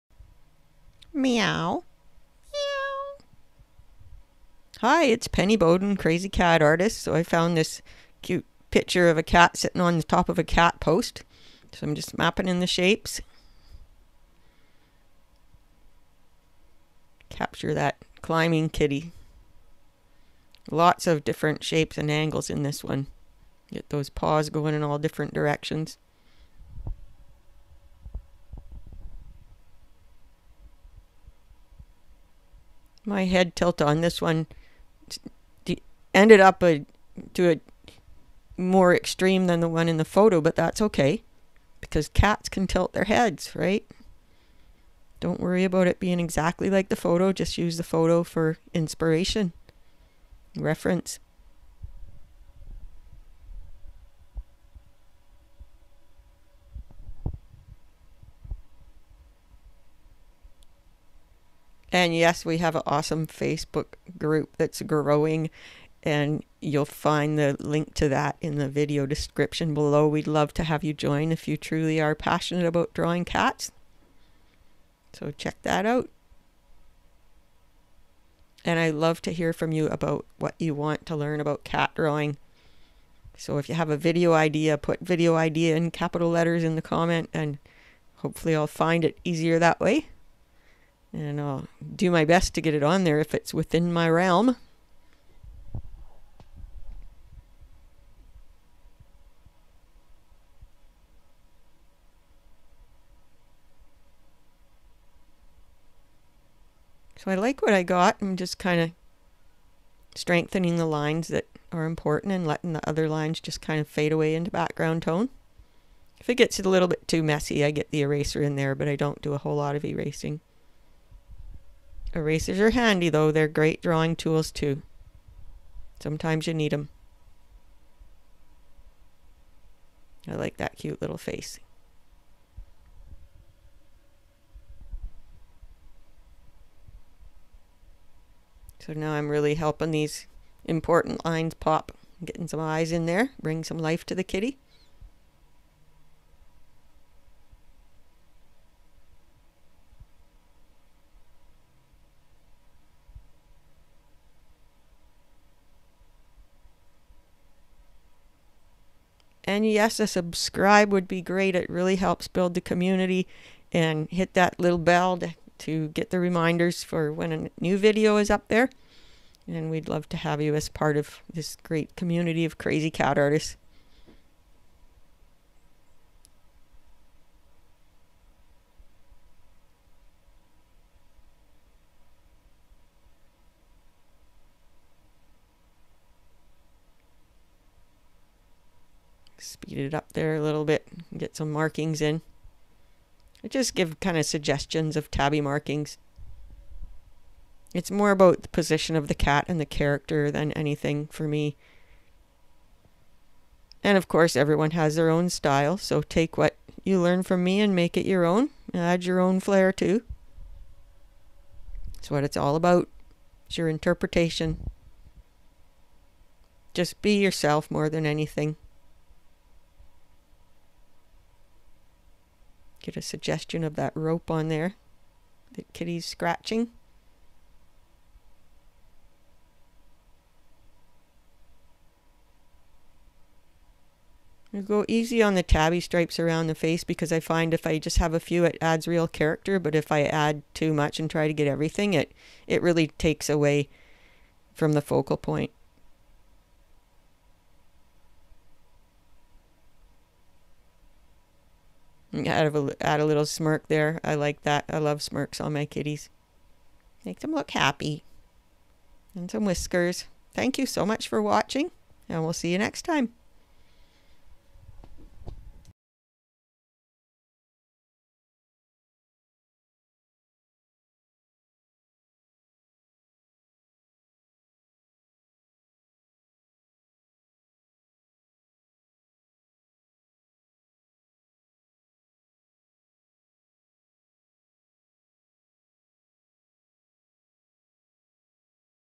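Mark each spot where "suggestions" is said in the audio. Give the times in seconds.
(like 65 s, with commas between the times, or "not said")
194 s, 223 s.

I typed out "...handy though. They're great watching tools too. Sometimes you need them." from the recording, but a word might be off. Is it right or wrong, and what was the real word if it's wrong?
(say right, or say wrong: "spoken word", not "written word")
wrong: "drawing", not "watching".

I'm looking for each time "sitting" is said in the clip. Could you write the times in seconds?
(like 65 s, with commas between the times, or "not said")
9 s.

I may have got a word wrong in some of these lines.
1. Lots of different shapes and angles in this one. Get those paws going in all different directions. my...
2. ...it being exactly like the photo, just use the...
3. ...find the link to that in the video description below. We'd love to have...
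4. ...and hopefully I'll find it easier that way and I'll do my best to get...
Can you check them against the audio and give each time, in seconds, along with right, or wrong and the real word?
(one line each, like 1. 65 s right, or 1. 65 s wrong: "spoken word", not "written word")
1. 20 s right
2. 45 s right
3. 66 s right
4. 87 s right.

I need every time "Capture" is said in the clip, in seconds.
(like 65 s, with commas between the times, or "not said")
17 s.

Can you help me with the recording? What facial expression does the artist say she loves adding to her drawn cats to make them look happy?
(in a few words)
Smirk.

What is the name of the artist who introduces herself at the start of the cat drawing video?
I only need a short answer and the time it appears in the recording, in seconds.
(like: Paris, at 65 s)
Penny Boden, at 5 s.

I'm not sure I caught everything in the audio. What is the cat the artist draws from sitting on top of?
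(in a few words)
A cat post.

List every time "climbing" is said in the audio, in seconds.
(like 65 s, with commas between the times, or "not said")
18 s.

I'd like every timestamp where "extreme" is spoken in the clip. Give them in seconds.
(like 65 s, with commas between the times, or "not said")
38 s.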